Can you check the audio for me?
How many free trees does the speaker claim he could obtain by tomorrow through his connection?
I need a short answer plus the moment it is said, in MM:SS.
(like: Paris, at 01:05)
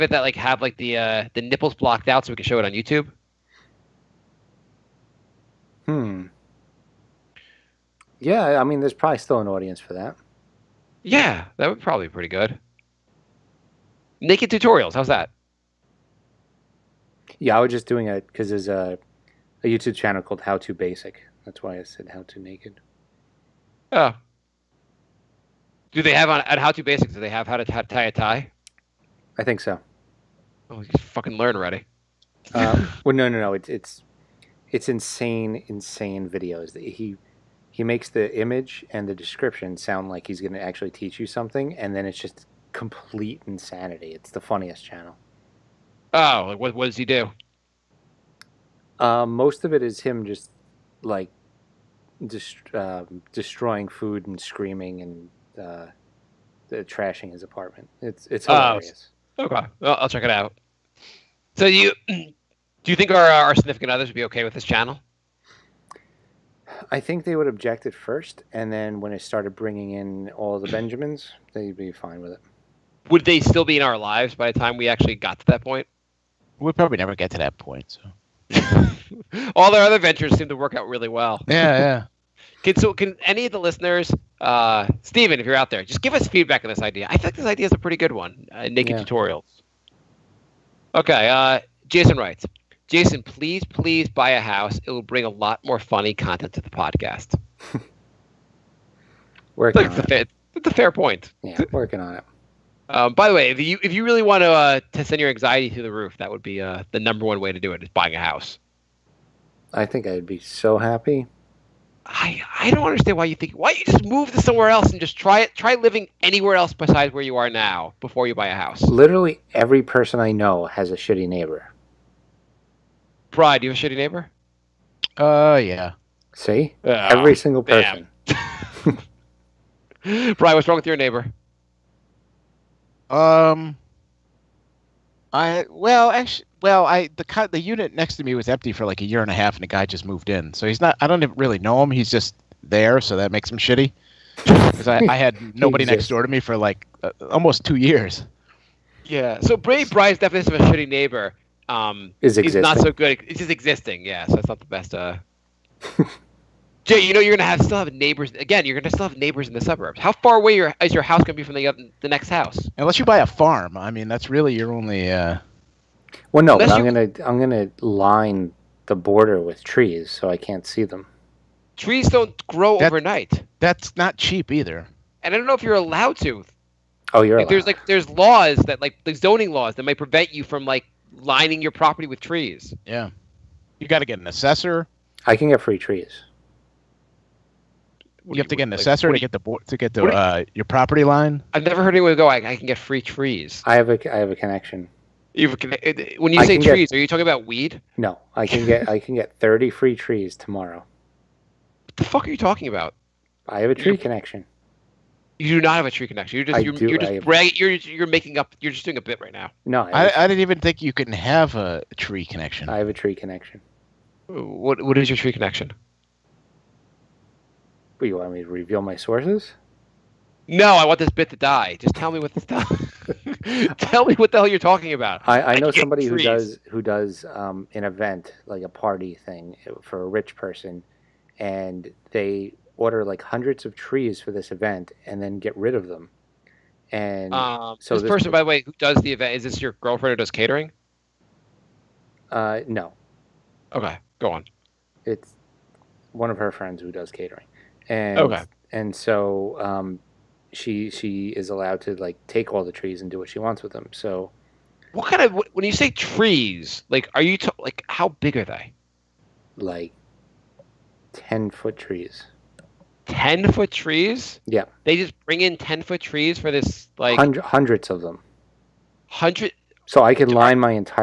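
30, at 03:19.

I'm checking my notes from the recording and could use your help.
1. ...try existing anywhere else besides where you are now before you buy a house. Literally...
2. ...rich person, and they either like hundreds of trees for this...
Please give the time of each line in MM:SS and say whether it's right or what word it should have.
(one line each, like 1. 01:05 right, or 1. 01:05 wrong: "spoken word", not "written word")
1. 01:55 wrong: "living", not "existing"
2. 03:50 wrong: "order", not "either".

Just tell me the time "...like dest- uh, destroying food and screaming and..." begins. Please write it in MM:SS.
00:51.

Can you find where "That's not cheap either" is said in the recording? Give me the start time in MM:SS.
02:53.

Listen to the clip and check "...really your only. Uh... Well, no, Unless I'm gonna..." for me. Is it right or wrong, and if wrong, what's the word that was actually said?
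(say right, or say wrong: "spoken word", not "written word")
right.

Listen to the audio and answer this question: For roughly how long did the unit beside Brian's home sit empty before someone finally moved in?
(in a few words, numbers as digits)
A year and a half.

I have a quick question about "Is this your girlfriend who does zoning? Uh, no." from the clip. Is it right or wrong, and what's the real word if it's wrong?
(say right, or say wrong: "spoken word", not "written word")
wrong: "catering", not "zoning".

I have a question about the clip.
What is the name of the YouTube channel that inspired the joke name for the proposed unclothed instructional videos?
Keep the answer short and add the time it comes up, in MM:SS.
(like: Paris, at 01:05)
How to Basic, at 00:20.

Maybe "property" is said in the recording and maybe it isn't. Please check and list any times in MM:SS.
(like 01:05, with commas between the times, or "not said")
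03:01, 03:10.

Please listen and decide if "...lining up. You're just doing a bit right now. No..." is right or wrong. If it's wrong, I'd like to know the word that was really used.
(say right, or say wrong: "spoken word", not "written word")
wrong: "making", not "lining".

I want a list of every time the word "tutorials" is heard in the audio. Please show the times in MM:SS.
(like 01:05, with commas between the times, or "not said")
00:14, 01:29.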